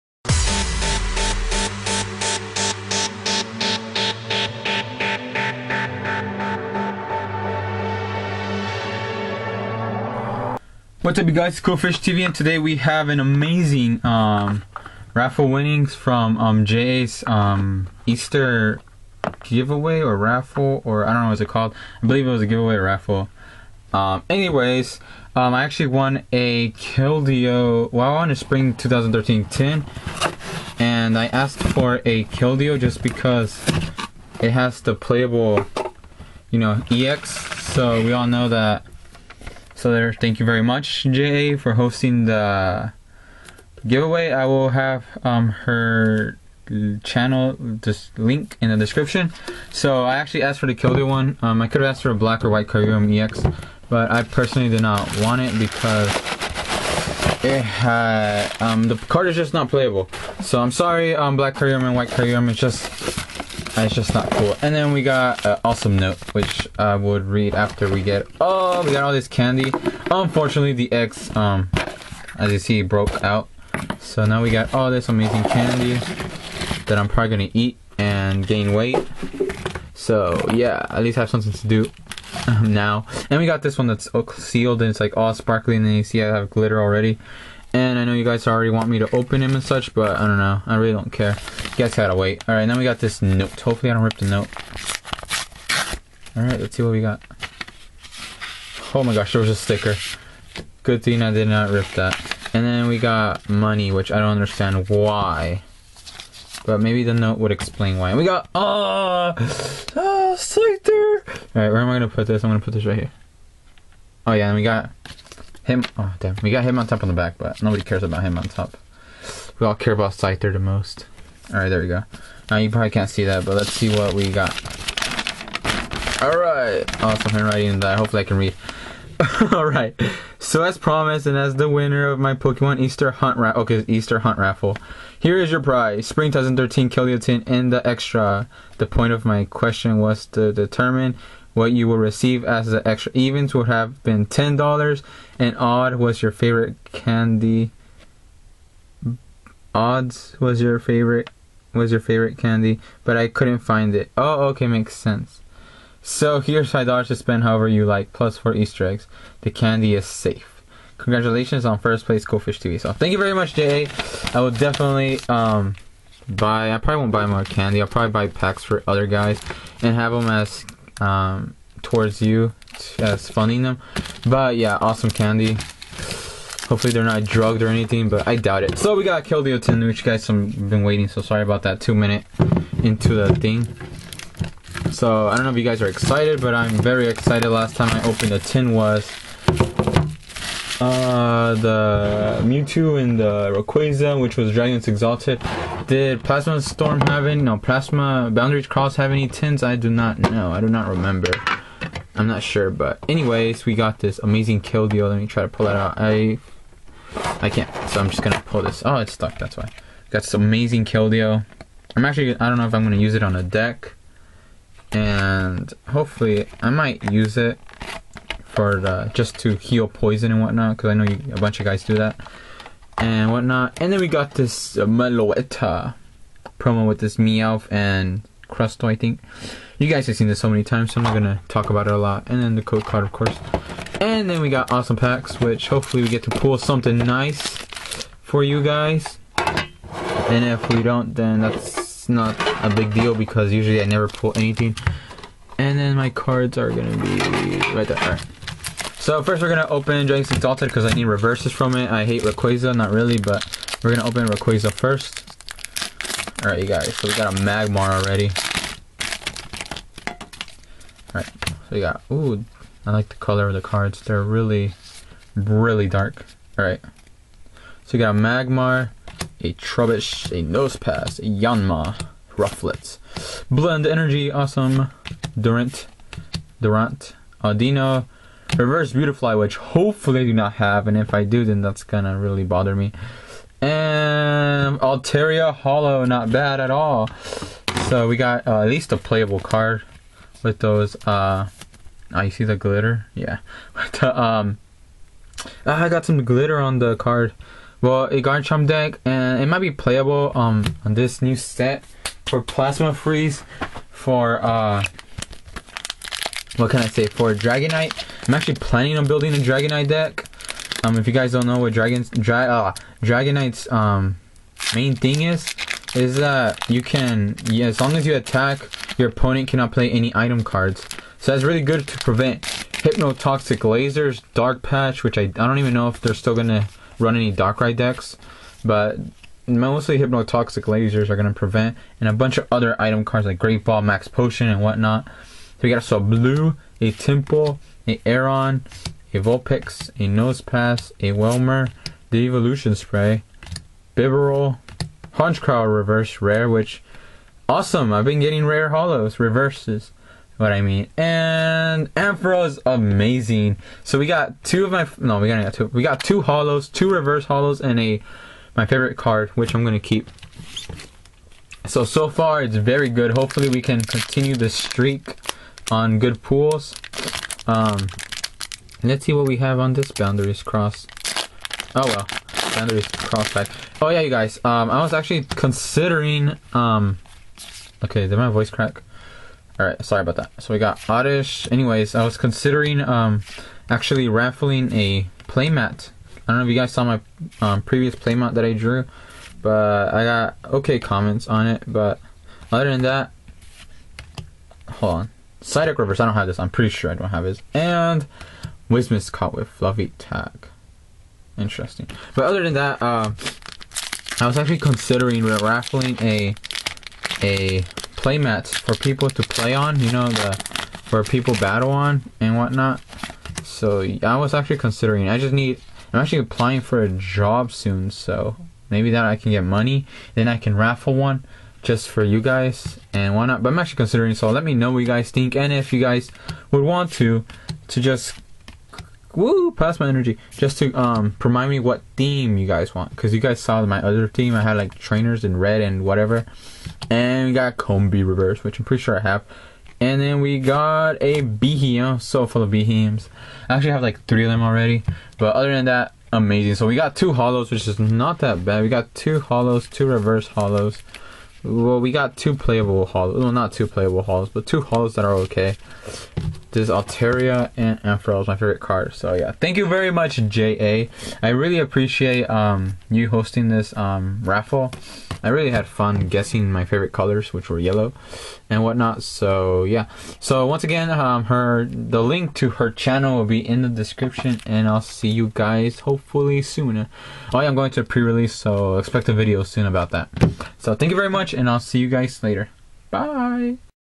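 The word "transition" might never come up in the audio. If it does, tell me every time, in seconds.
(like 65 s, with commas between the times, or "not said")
not said.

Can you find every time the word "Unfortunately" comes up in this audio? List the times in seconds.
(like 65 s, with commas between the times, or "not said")
70 s.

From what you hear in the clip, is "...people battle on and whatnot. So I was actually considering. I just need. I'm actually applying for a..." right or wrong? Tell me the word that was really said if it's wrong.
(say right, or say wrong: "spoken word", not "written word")
right.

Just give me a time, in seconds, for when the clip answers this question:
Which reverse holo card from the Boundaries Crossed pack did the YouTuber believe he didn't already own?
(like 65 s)
395 s.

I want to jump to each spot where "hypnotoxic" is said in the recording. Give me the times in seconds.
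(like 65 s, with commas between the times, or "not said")
322 s, 329 s.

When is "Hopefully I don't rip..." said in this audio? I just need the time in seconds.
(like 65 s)
93 s.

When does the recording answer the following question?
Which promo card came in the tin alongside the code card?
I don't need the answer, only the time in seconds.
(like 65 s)
224 s.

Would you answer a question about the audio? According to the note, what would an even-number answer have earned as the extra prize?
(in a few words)
$10.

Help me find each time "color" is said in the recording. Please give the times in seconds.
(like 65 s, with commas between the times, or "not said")
263 s, 466 s.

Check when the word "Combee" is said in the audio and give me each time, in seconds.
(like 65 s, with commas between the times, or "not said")
437 s.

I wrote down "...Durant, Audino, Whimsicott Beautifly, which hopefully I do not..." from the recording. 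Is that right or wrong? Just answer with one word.
wrong.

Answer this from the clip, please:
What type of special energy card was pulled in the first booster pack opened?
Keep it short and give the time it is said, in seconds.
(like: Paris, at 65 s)
Blend Energy, at 273 s.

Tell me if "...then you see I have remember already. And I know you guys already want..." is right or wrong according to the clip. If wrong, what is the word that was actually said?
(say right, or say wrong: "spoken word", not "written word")
wrong: "glitter", not "remember".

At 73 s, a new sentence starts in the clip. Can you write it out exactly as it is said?
So now we got all this amazing candy that I'm probably gonna eat and gain weight.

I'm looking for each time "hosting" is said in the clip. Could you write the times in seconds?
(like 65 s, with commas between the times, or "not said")
41 s, 463 s.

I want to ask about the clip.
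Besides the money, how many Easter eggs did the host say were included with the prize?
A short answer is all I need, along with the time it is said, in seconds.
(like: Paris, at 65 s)
4, at 158 s.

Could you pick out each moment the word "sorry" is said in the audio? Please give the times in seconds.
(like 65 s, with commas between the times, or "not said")
60 s, 181 s, 379 s.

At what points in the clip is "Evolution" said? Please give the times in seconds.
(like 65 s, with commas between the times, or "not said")
342 s.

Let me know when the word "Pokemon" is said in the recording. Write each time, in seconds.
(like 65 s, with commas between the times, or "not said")
132 s.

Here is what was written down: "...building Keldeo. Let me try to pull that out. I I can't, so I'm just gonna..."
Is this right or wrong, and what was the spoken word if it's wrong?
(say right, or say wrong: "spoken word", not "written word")
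wrong: "amazing", not "building".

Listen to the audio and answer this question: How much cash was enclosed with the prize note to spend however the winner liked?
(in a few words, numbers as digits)
$5.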